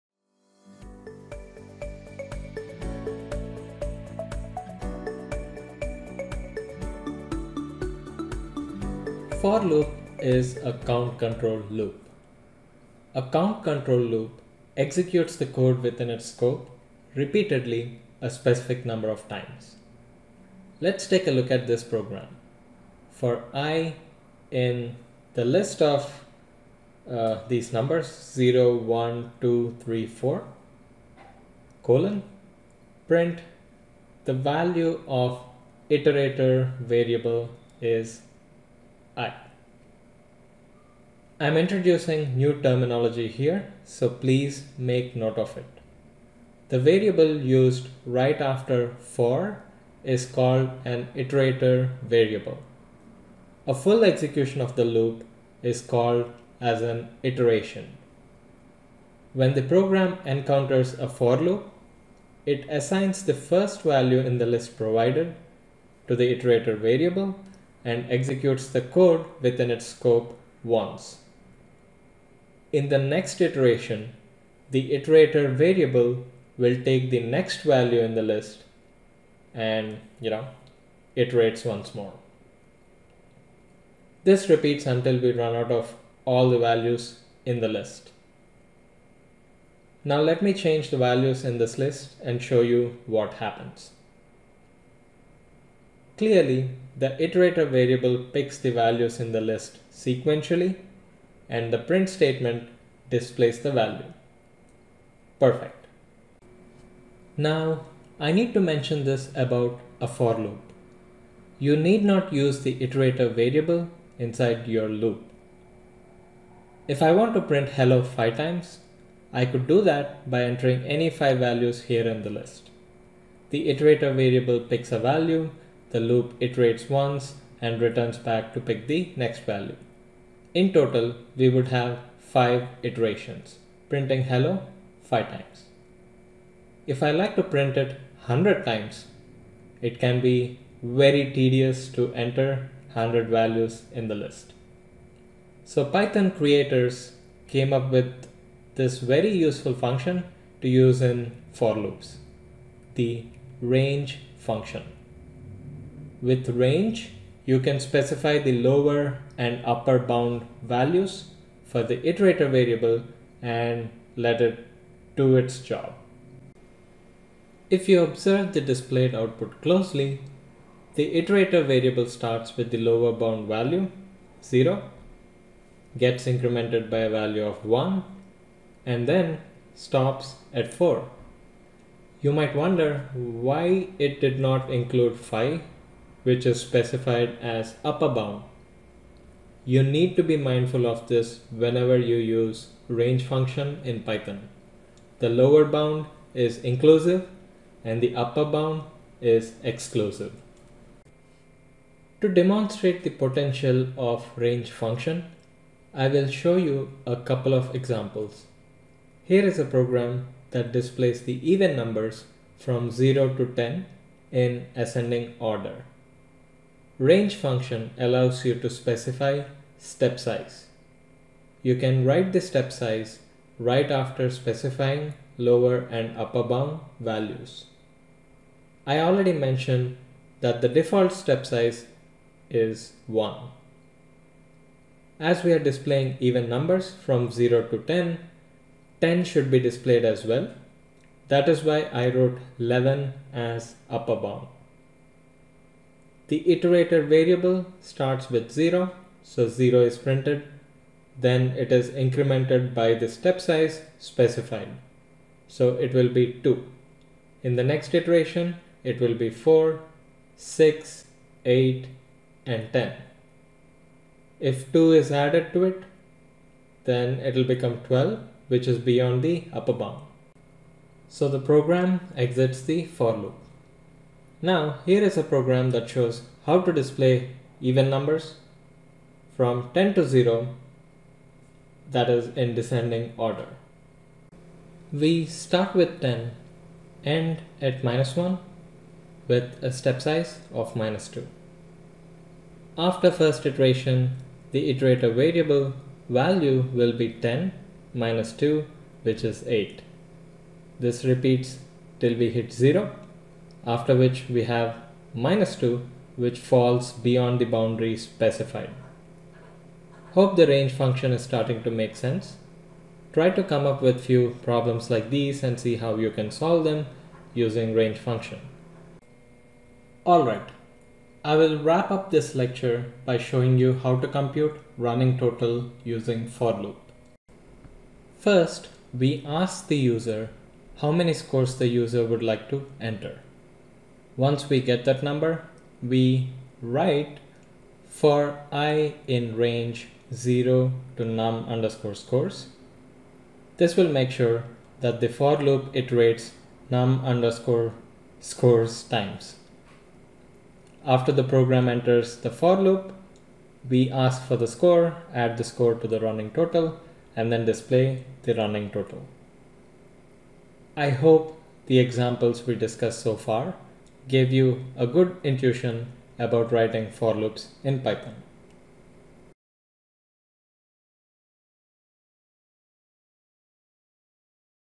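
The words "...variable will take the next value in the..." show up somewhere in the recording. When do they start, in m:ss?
1:15.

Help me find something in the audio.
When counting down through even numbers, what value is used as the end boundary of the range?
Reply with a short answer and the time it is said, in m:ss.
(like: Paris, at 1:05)
-1, at 4:47.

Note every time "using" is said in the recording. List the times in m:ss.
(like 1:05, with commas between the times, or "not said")
5:17, 5:25.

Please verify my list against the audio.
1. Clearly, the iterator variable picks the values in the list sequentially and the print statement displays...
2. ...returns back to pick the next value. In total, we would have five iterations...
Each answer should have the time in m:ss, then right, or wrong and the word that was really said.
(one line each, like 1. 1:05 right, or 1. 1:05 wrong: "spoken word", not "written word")
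1. 1:36 right
2. 2:07 right.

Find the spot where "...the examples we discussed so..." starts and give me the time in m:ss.
6:01.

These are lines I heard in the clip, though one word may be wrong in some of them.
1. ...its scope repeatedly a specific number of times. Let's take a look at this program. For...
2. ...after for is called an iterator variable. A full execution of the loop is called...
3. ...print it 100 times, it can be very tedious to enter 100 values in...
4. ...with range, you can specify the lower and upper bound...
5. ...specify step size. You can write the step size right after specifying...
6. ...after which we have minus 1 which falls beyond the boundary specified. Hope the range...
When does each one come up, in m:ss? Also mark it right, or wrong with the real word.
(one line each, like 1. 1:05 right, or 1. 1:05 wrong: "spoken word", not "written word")
1. 0:16 right
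2. 0:48 right
3. 2:17 right
4. 2:36 right
5. 3:38 right
6. 5:03 wrong: "2", not "1".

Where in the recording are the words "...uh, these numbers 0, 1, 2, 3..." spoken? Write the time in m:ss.
0:27.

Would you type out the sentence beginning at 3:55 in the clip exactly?
As we are displaying even numbers from 0 to 10, 10 should be displayed as well.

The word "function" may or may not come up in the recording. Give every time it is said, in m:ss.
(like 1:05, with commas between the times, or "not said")
2:29, 2:34, 3:13, 3:24, 3:37, 5:10, 5:17.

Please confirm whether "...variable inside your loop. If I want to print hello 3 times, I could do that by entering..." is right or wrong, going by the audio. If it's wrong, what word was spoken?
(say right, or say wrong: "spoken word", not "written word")
wrong: "5", not "3".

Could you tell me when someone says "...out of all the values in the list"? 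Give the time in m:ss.
1:25.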